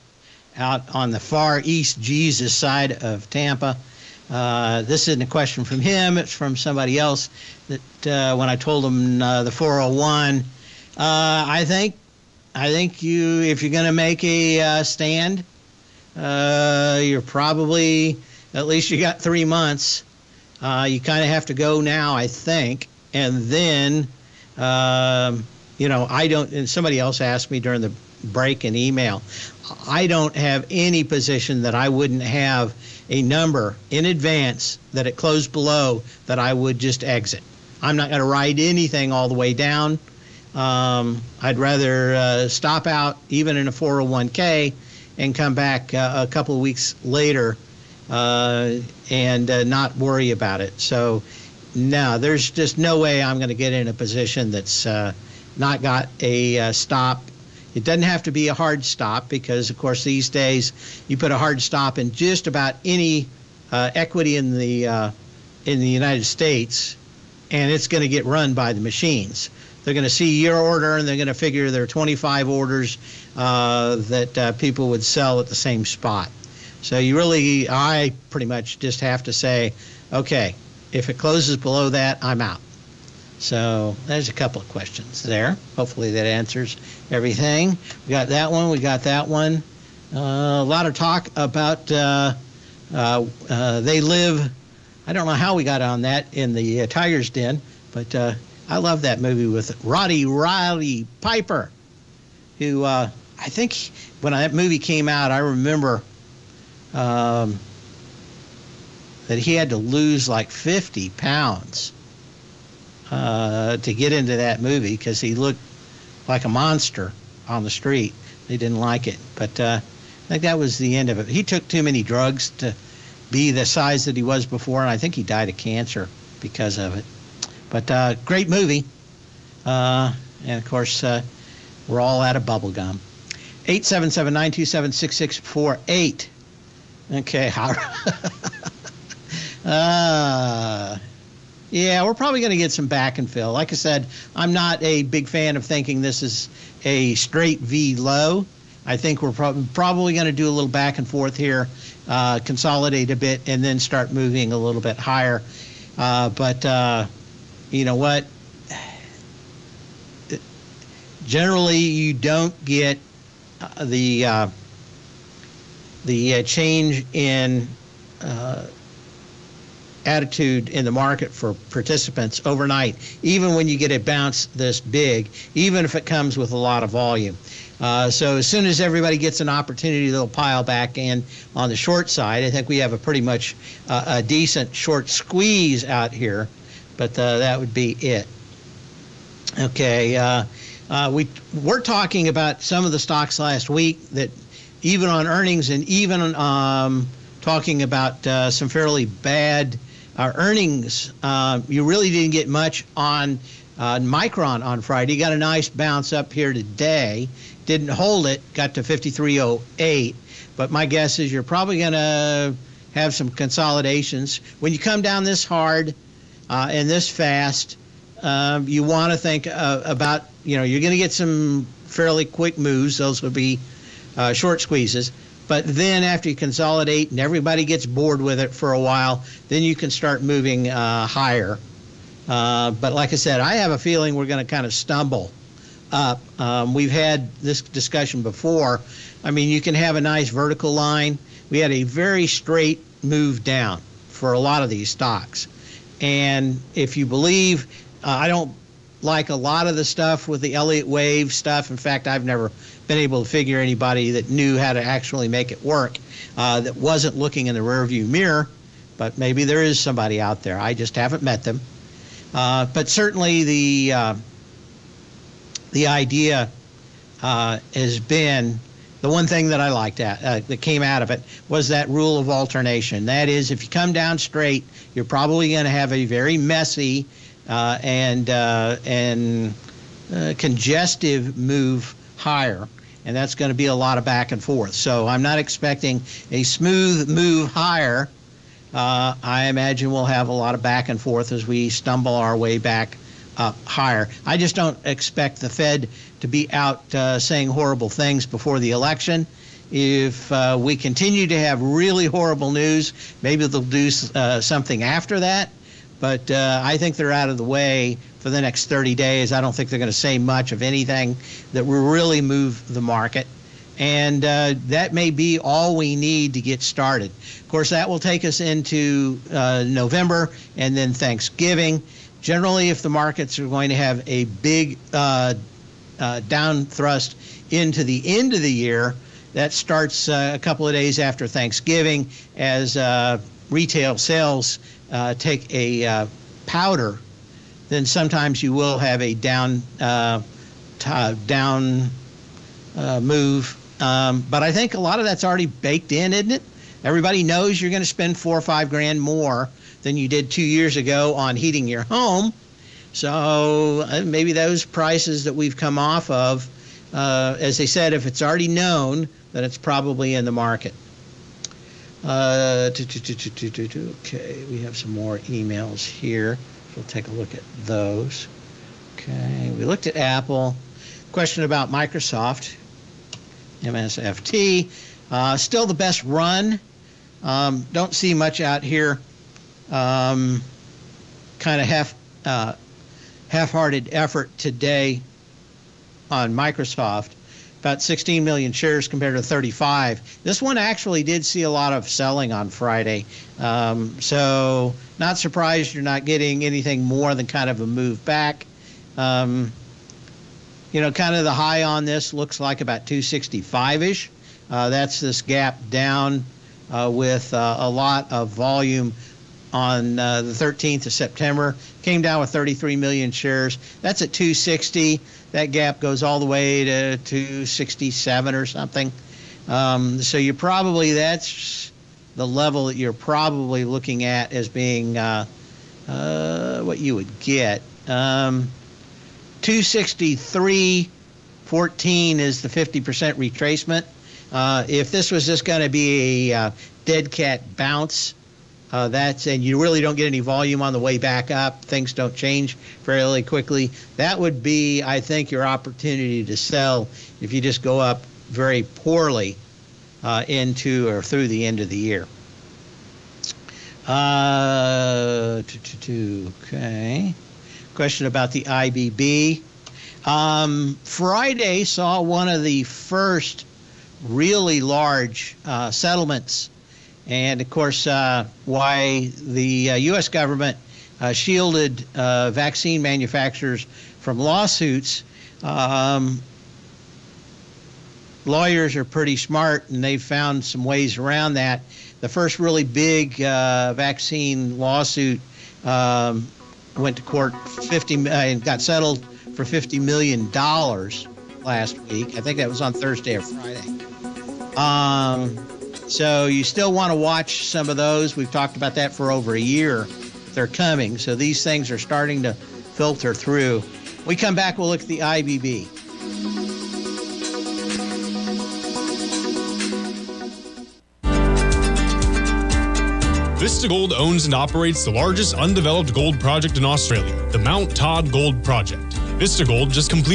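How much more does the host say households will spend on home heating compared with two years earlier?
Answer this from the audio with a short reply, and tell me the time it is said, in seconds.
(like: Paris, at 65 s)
four or five grand, at 348 s.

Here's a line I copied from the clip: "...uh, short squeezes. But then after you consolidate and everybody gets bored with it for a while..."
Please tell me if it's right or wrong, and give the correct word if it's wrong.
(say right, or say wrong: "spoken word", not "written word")
right.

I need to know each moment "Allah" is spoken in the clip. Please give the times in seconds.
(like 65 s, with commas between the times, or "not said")
not said.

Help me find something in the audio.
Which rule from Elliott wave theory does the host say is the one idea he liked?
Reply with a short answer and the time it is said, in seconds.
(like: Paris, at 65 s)
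rule of alternation, at 271 s.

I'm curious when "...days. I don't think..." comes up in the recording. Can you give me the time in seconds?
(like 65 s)
308 s.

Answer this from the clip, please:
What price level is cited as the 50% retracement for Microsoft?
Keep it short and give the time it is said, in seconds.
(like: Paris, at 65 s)
263.14, at 429 s.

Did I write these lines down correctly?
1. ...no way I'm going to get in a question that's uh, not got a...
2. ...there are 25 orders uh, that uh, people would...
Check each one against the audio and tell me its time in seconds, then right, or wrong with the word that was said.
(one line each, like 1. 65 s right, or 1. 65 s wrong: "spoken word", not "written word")
1. 52 s wrong: "position", not "question"
2. 71 s right.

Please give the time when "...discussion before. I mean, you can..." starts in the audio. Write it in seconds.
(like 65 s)
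237 s.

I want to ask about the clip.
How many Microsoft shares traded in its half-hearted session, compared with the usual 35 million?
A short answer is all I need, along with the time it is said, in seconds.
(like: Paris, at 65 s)
16 million, at 387 s.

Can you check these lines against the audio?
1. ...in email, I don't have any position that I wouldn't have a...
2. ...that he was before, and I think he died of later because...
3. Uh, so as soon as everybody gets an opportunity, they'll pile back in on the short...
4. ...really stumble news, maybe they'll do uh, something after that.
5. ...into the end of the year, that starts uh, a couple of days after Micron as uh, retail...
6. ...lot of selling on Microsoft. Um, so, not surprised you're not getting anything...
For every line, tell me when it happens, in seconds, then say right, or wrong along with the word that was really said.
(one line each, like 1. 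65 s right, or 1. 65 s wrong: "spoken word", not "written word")
1. 28 s right
2. 124 s wrong: "cancer", not "later"
3. 177 s right
4. 301 s wrong: "horrible", not "stumble"
5. 327 s wrong: "Thanksgiving", not "Micron"
6. 391 s wrong: "Friday", not "Microsoft".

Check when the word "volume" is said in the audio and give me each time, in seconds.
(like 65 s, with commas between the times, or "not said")
176 s, 408 s, 440 s.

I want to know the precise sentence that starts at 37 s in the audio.
I'm not going to ride anything all the way down.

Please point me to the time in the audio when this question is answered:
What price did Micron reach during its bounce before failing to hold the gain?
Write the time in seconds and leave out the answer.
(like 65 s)
208 s.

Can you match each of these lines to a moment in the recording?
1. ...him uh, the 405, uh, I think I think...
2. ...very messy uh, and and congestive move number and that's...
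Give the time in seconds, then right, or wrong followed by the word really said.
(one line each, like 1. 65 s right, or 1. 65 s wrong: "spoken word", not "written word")
1. 8 s wrong: "401", not "405"
2. 276 s wrong: "higher", not "number".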